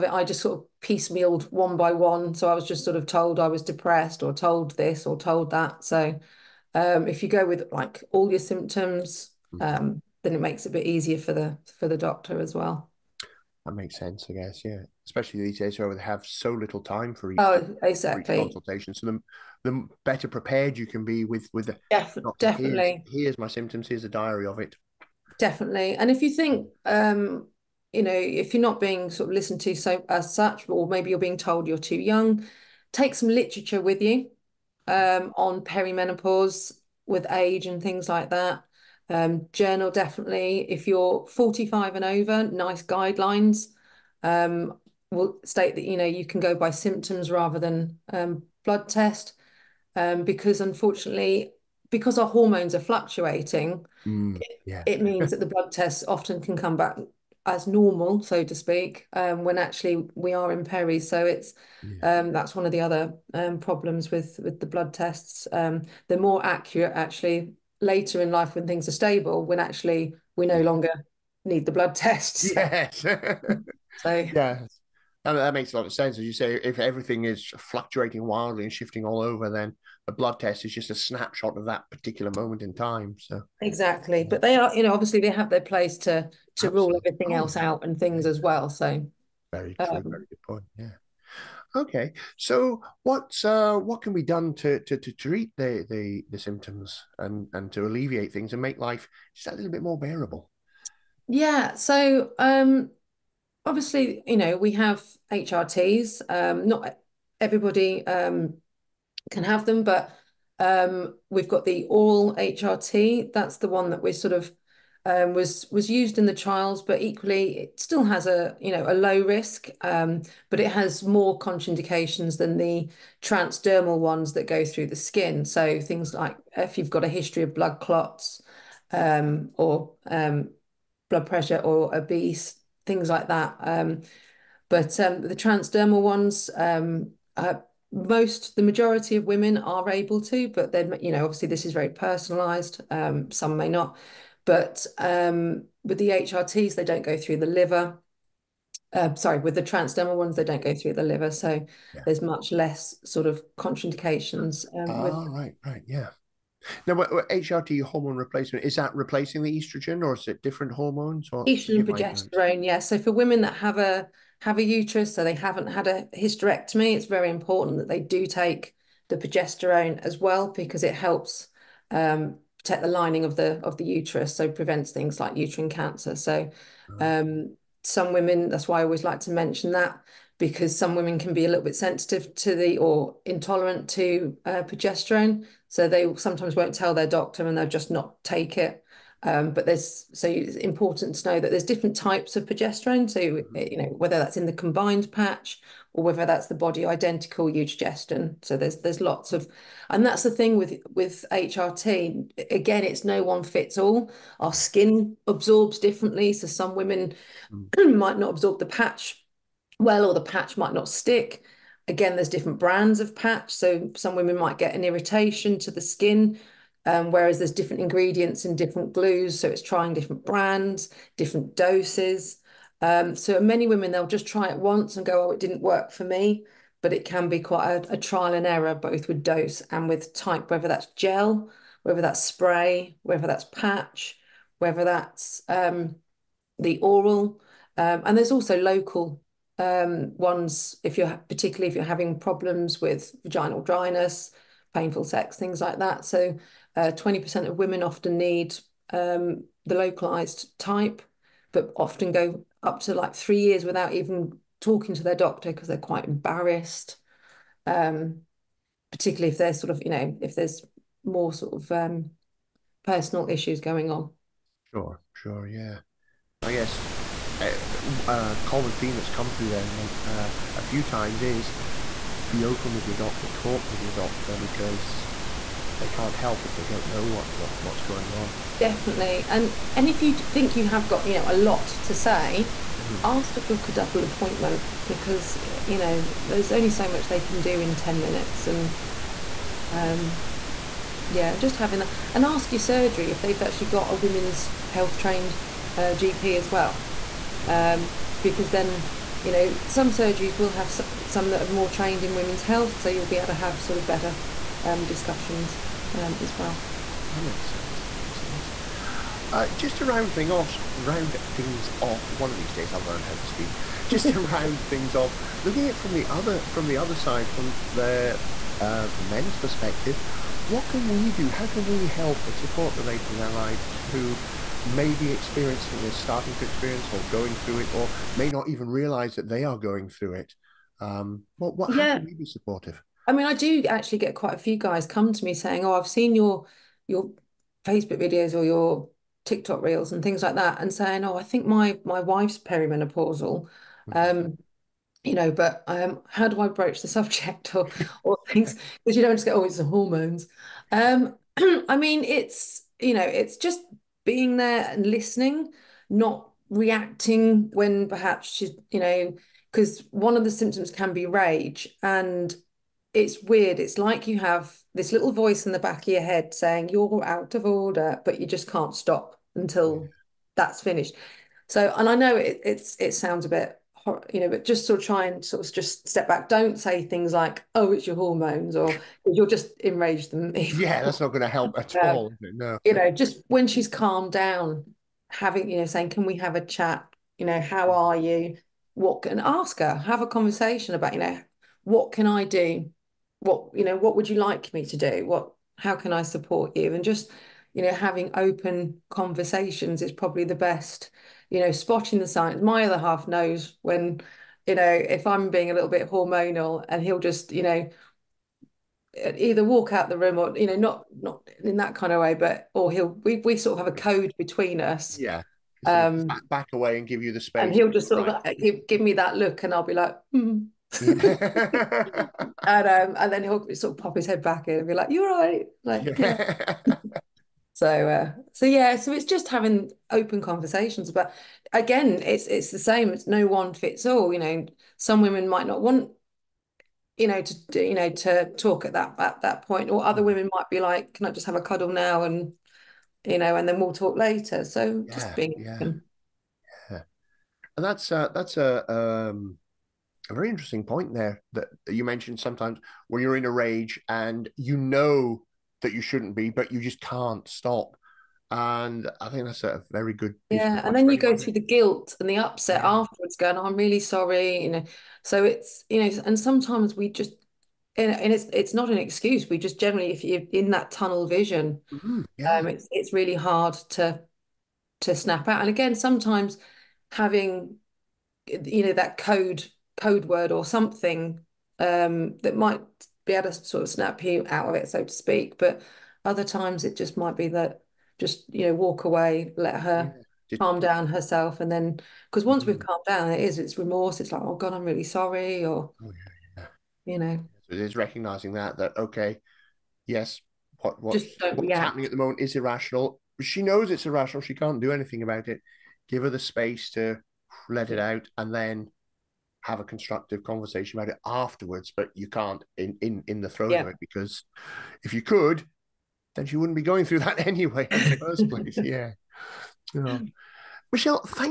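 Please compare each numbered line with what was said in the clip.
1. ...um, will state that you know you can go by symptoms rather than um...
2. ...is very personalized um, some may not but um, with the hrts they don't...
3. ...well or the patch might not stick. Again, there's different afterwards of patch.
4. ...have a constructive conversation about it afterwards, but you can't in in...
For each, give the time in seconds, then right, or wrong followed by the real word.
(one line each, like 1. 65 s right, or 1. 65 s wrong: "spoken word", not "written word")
1. 44 s right
2. 141 s right
3. 209 s wrong: "brands", not "afterwards"
4. 509 s right.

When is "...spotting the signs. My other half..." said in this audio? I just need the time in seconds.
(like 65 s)
401 s.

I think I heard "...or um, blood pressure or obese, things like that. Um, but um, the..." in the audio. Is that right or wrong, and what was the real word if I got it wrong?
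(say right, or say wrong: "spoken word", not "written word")
right.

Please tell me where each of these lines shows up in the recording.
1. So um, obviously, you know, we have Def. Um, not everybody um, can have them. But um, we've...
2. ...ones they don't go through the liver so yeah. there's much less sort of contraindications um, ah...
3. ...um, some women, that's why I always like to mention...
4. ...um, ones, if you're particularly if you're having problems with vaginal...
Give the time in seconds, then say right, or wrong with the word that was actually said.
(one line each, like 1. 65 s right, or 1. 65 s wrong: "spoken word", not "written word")
1. 101 s wrong: "HRTs", not "Def"
2. 150 s right
3. 176 s right
4. 239 s right.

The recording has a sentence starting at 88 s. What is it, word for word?
So very um, true, um, very good point.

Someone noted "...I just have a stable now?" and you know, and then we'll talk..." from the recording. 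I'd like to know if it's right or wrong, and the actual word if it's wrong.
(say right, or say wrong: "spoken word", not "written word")
wrong: "cuddle", not "stable".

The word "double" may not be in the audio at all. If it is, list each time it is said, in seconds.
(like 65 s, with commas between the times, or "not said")
283 s.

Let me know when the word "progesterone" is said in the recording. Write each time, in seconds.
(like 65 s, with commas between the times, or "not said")
161 s, 169 s, 184 s, 192 s.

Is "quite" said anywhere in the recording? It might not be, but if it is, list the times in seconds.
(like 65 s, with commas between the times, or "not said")
227 s, 255 s, 334 s.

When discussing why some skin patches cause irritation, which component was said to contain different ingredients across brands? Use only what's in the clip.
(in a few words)
Glues.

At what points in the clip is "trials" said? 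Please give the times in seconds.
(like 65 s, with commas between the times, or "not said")
116 s, 227 s.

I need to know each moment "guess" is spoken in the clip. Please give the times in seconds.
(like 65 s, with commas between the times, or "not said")
14 s, 266 s.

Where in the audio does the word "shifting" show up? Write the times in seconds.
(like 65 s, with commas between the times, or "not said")
78 s.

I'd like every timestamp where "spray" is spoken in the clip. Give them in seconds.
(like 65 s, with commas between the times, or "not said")
232 s.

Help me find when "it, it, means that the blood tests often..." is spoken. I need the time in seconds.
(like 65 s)
54 s.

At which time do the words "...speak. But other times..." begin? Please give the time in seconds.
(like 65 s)
484 s.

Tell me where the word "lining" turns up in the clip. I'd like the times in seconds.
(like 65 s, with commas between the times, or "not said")
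172 s.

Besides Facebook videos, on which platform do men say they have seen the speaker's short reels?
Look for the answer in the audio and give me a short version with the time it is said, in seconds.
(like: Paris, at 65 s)
TikTok, at 339 s.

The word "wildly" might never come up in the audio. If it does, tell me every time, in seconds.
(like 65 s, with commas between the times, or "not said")
78 s.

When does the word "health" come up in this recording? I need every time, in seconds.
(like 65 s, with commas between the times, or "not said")
294 s, 302 s.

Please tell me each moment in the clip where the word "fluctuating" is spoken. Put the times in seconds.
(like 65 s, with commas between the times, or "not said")
52 s, 77 s.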